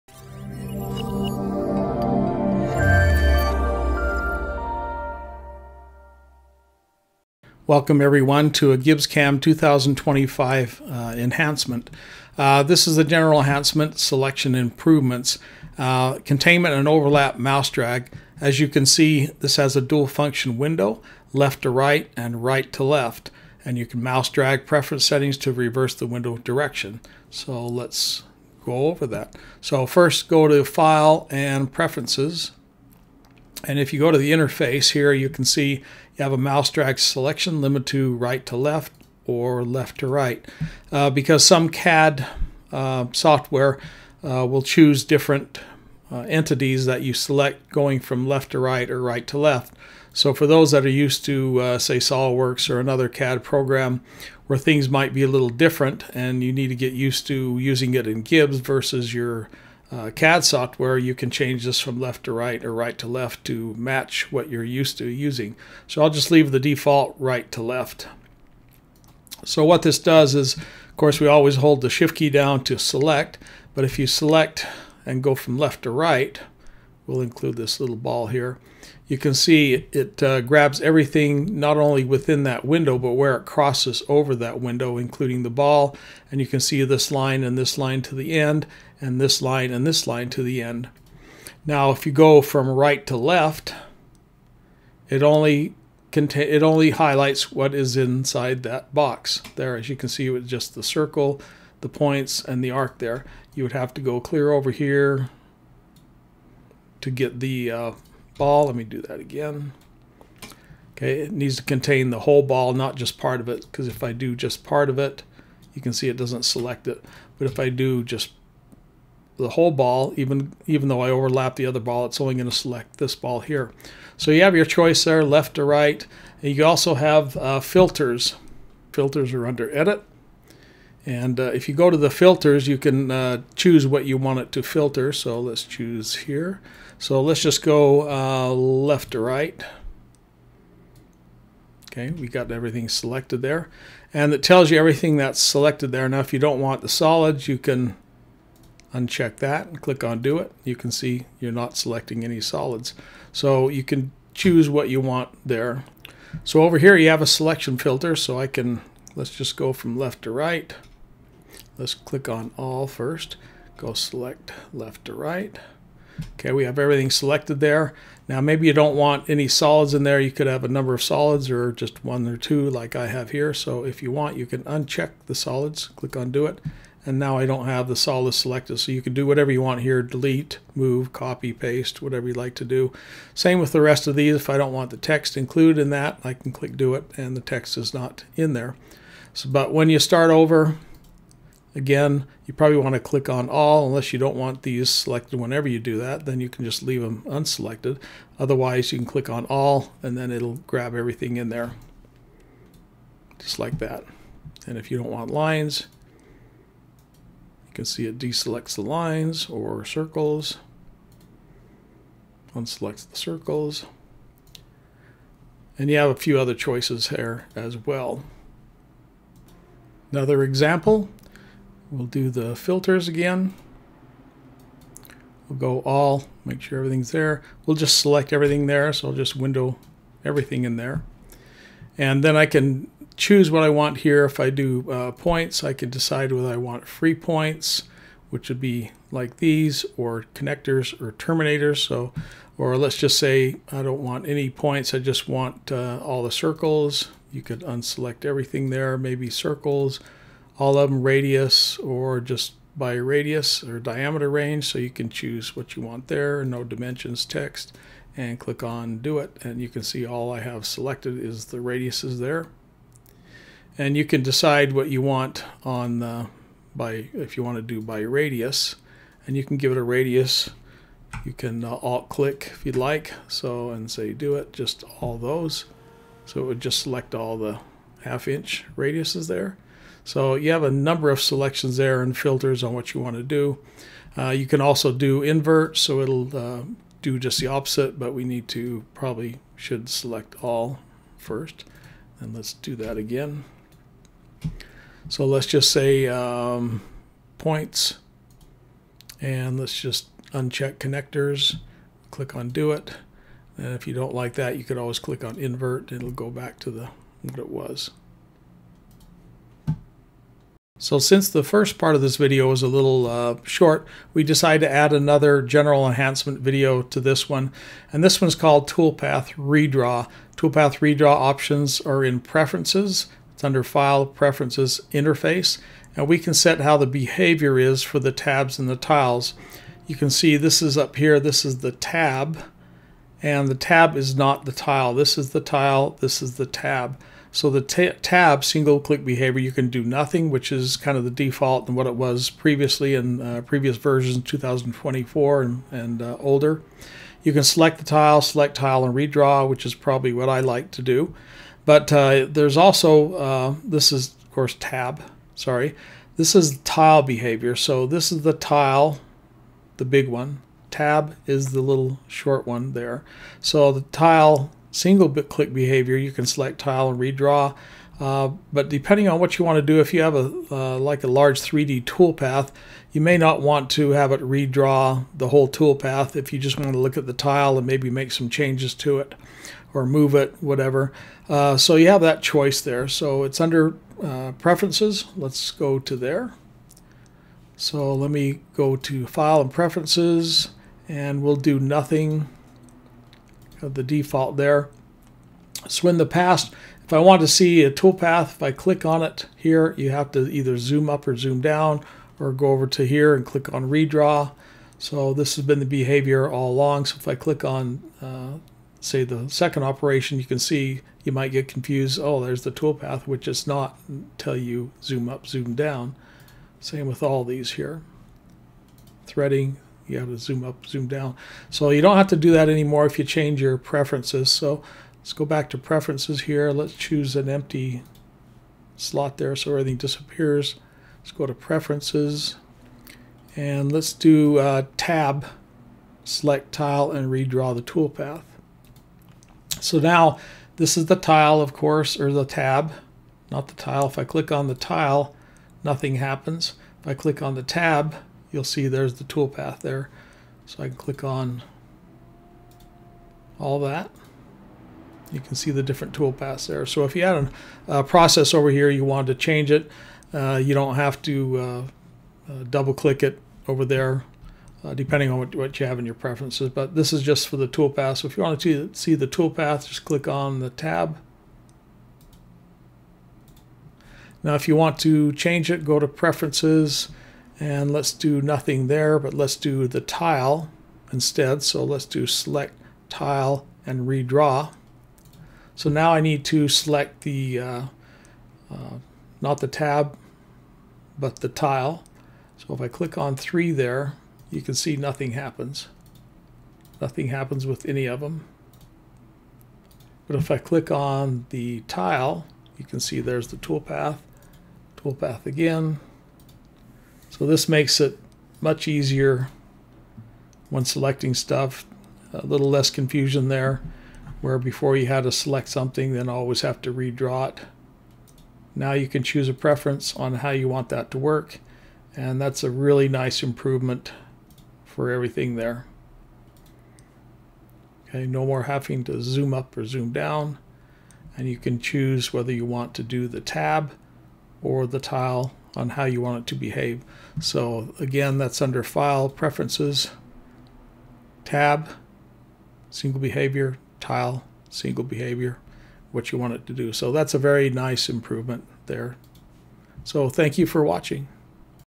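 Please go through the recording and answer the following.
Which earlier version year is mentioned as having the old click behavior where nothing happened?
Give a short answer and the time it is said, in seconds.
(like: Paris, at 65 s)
2024, at 344 s.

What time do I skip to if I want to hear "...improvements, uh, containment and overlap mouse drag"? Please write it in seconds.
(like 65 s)
14 s.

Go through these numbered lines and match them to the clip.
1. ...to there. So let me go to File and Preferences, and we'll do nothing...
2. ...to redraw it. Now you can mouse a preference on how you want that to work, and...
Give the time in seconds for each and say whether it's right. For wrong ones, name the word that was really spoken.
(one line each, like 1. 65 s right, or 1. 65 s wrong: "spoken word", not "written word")
1. 385 s right
2. 516 s wrong: "choose", not "mouse".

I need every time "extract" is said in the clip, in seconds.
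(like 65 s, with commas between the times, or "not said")
not said.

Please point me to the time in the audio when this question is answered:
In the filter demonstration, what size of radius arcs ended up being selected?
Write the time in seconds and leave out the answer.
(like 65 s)
278 s.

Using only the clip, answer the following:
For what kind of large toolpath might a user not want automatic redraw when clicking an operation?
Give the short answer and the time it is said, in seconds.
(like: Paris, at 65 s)
3D toolpath, at 371 s.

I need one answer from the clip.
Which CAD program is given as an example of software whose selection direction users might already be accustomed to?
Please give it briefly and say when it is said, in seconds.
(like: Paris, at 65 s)
SOLIDWORKS, at 51 s.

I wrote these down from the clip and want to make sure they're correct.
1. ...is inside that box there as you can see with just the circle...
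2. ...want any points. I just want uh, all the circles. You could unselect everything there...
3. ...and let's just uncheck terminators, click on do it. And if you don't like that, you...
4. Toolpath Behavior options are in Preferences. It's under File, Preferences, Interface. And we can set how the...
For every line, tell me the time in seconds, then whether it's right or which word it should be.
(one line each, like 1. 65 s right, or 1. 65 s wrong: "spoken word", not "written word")
1. 97 s right
2. 244 s right
3. 299 s wrong: "connectors", not "terminators"
4. 320 s wrong: "Redraw", not "Behavior".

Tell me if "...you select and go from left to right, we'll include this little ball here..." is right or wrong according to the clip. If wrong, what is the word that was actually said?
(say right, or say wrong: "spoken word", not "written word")
right.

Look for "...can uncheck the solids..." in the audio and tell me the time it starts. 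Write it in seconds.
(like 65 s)
174 s.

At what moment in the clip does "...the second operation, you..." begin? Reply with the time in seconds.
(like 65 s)
409 s.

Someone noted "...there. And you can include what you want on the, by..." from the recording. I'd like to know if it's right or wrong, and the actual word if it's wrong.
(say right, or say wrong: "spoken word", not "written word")
wrong: "decide", not "include".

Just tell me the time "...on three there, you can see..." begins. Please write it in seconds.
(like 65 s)
492 s.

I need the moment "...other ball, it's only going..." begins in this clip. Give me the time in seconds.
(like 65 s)
121 s.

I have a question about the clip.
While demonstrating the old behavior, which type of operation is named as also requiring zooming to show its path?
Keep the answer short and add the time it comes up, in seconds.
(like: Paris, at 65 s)
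Threading, at 419 s.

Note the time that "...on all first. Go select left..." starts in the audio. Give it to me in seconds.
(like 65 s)
162 s.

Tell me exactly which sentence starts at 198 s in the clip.
Otherwise, you can click on all and then it'll grab everything in there, just like that.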